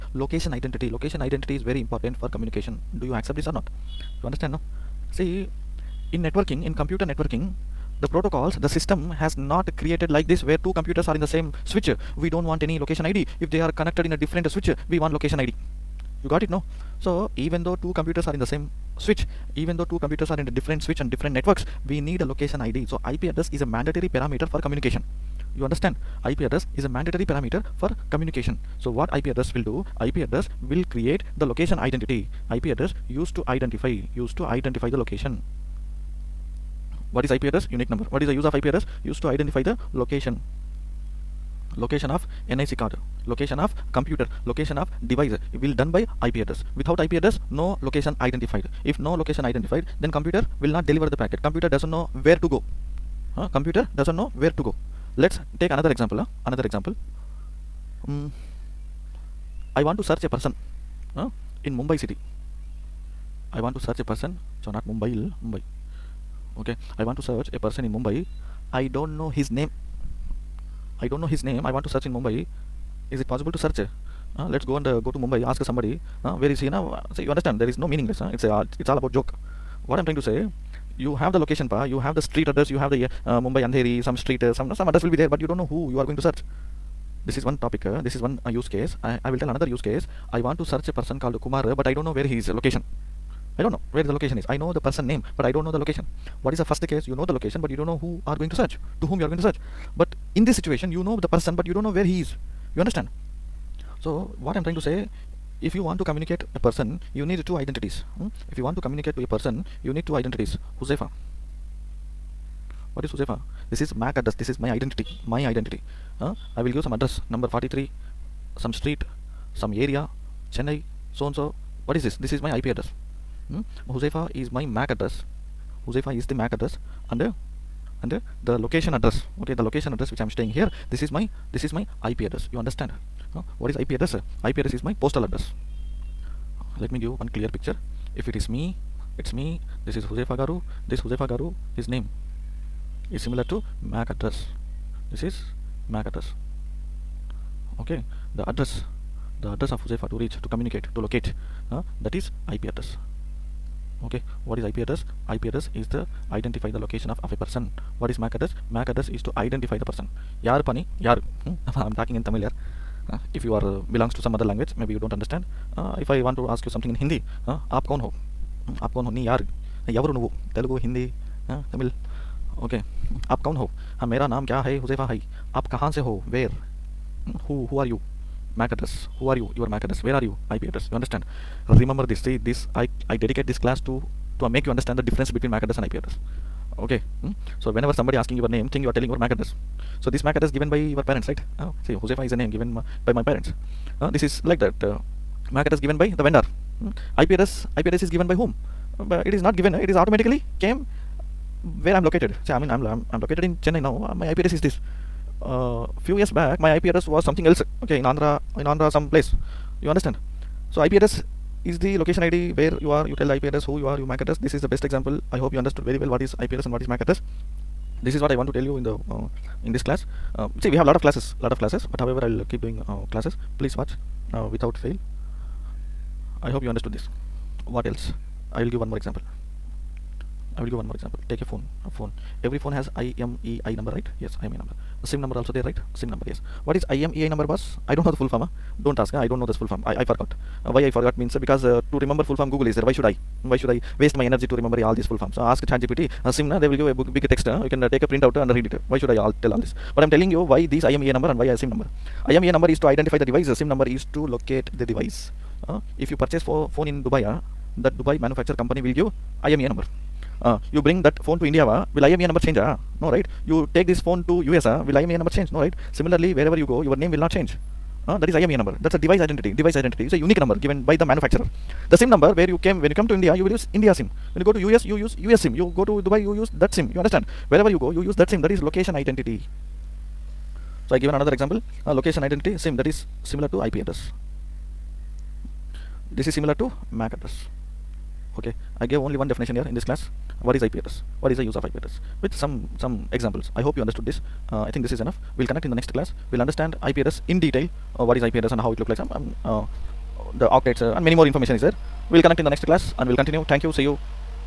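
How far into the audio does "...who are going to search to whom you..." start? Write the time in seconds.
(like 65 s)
98 s.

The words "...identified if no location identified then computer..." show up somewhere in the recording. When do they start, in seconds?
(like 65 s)
48 s.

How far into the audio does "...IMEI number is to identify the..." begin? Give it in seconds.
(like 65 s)
252 s.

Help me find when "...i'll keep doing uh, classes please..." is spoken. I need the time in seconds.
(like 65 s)
222 s.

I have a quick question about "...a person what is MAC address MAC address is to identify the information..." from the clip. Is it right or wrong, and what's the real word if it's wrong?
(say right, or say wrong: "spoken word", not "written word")
wrong: "person", not "information".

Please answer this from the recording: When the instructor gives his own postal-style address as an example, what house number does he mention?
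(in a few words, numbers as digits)
43.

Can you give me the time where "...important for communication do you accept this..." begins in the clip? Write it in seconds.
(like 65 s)
1 s.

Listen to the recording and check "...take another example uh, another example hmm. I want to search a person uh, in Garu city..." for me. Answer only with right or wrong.
wrong.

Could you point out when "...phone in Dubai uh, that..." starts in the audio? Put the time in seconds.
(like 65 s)
256 s.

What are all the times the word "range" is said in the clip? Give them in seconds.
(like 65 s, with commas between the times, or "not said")
not said.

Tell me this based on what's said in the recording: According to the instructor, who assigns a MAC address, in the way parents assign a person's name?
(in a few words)
The vendor.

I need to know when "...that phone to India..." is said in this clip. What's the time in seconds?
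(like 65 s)
261 s.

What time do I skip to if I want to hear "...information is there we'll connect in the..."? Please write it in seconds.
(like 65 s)
301 s.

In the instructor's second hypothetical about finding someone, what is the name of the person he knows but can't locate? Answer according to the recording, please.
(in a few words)
Kumar.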